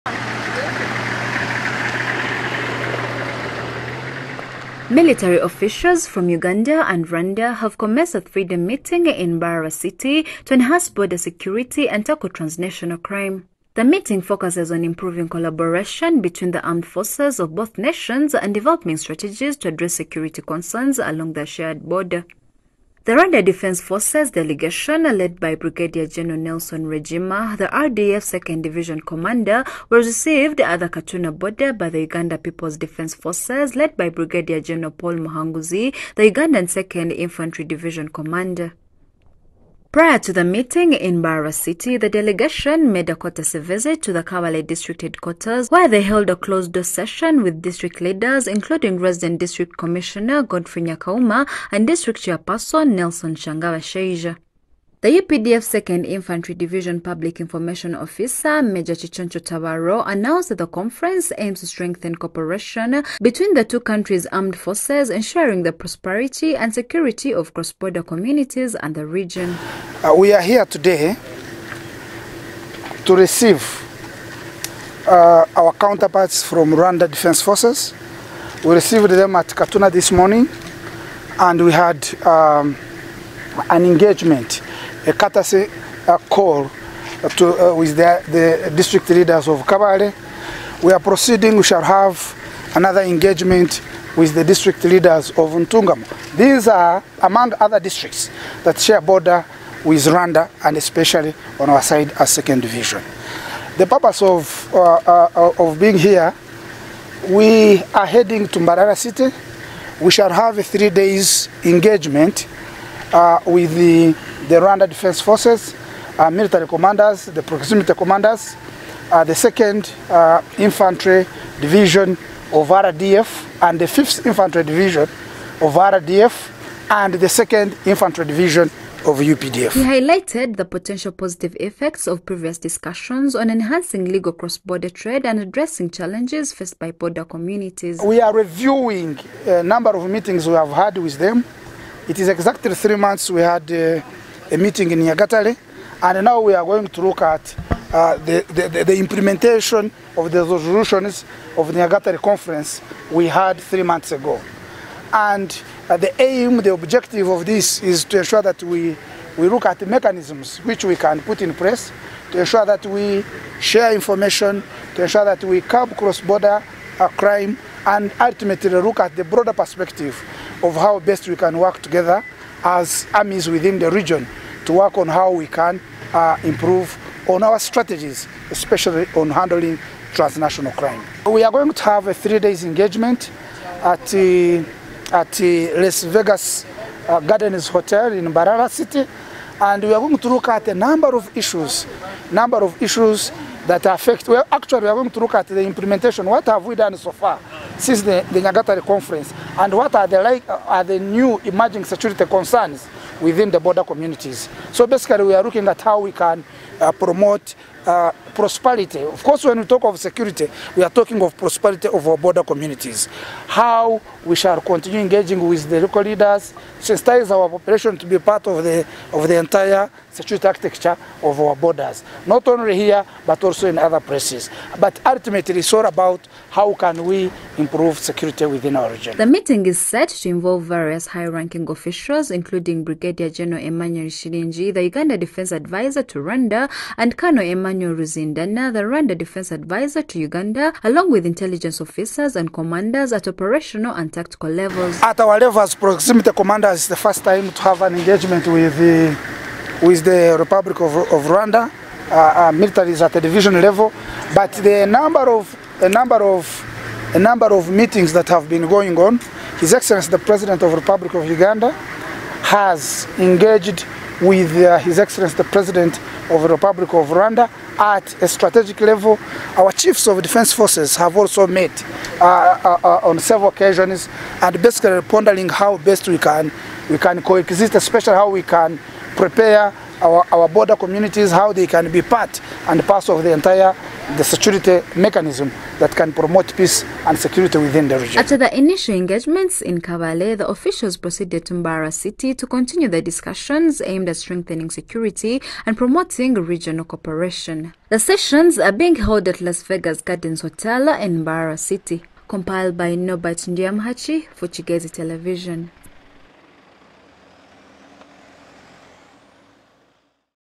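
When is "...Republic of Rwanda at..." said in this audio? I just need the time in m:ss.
4:26.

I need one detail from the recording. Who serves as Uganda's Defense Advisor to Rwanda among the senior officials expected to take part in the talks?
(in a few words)
Emmanuel Shilinji.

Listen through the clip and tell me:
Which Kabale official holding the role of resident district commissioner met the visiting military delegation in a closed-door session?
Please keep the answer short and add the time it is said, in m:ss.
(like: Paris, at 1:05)
Godfrey Nyakauma, at 0:50.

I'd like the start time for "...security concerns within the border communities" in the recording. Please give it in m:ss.
3:21.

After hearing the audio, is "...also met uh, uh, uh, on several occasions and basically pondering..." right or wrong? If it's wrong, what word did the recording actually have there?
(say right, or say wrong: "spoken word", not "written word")
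right.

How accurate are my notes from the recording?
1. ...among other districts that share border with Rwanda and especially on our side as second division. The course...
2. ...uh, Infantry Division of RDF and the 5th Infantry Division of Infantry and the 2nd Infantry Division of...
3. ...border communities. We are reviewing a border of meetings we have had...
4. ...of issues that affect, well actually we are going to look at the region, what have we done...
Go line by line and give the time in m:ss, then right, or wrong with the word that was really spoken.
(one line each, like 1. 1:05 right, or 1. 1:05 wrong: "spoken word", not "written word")
1. 1:37 wrong: "purpose", not "course"
2. 2:00 wrong: "RDF", not "Infantry"
3. 2:16 wrong: "number", not "border"
4. 3:12 wrong: "implementation", not "region".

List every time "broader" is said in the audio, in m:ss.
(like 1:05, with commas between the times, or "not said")
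2:49.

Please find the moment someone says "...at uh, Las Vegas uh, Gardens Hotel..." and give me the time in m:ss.
3:05.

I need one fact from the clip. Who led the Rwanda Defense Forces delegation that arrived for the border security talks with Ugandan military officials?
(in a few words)
Nelson Regima.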